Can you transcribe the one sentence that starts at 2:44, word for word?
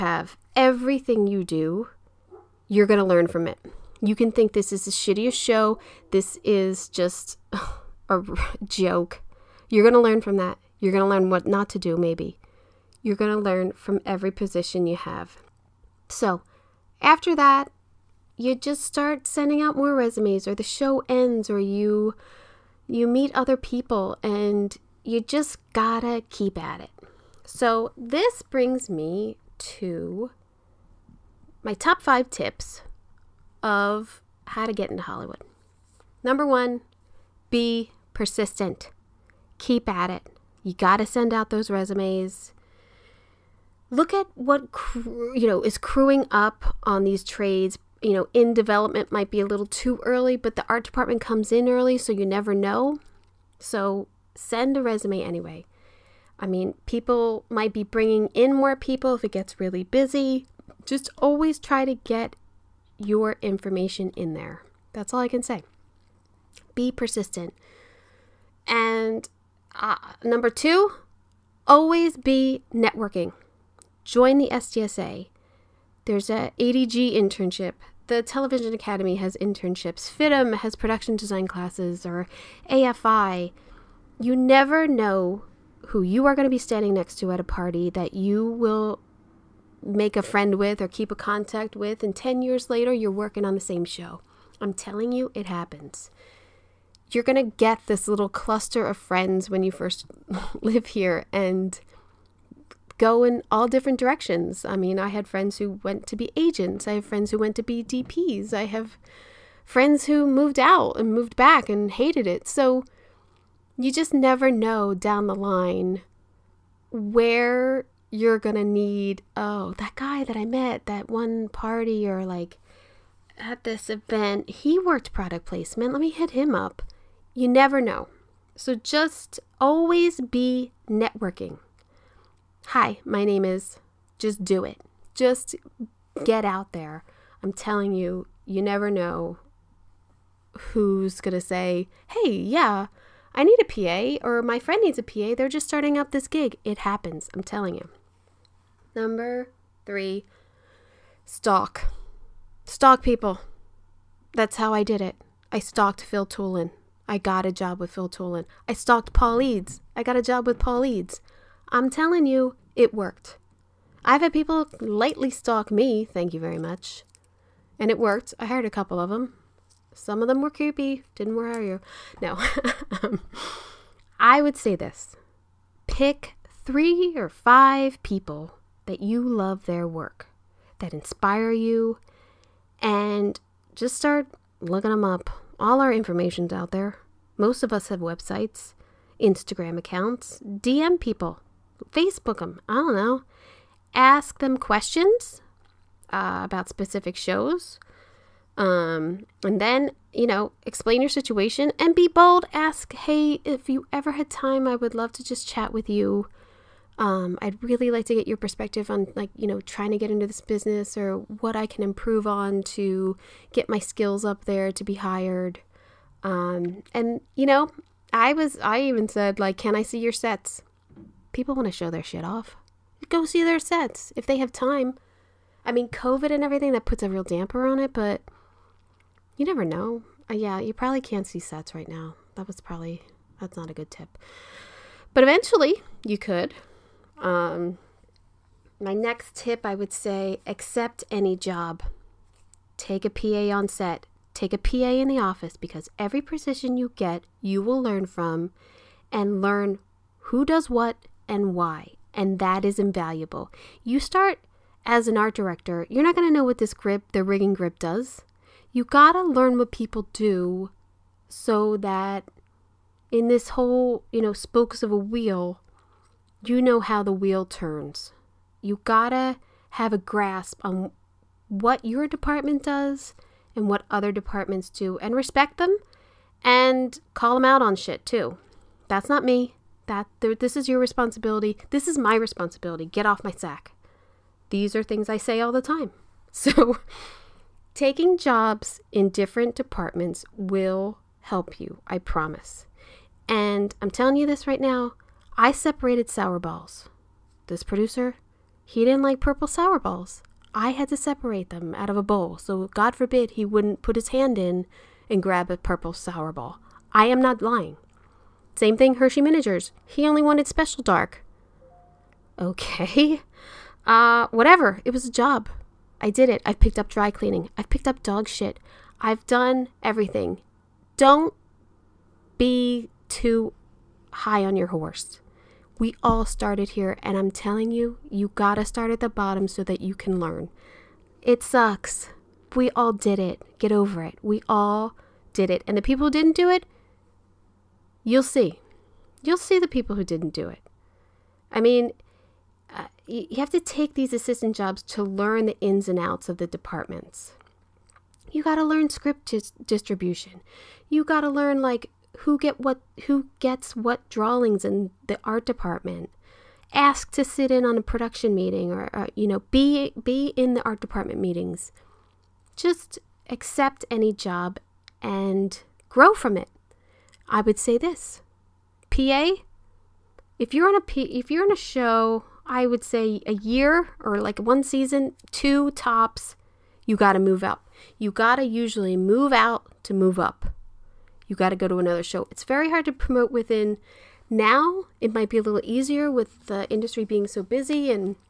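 I've had people lightly stalk me, thank you very much.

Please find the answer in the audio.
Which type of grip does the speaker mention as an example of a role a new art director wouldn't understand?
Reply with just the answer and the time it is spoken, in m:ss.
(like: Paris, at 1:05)
Rigging grip, at 4:17.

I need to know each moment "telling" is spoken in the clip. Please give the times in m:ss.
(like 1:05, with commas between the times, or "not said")
1:34, 2:17, 2:27, 2:41, 4:53, 5:27.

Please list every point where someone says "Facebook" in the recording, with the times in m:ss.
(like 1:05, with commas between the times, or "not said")
3:11.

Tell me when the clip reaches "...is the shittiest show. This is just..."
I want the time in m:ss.
0:04.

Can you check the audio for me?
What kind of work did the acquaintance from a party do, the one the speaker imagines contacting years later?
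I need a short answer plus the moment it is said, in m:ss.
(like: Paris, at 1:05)
Product placement, at 2:05.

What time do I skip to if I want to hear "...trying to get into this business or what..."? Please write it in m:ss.
3:29.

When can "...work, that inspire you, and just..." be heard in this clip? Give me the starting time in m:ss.
2:59.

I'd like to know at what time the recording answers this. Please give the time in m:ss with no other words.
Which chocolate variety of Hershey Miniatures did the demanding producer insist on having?
5:10.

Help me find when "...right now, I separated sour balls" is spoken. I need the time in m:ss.
4:54.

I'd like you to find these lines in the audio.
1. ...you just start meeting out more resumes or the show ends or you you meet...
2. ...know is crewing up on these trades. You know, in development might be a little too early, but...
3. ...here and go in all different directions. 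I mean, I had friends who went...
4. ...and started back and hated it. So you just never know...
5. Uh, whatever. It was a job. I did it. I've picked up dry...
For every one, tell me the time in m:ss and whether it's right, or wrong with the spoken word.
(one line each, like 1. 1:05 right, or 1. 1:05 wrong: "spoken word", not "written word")
1. 0:18 wrong: "sending", not "meeting"
2. 0:45 right
3. 1:40 right
4. 1:50 wrong: "moved", not "started"
5. 5:13 right.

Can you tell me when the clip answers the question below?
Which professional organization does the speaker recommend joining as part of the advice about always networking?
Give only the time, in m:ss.
1:14.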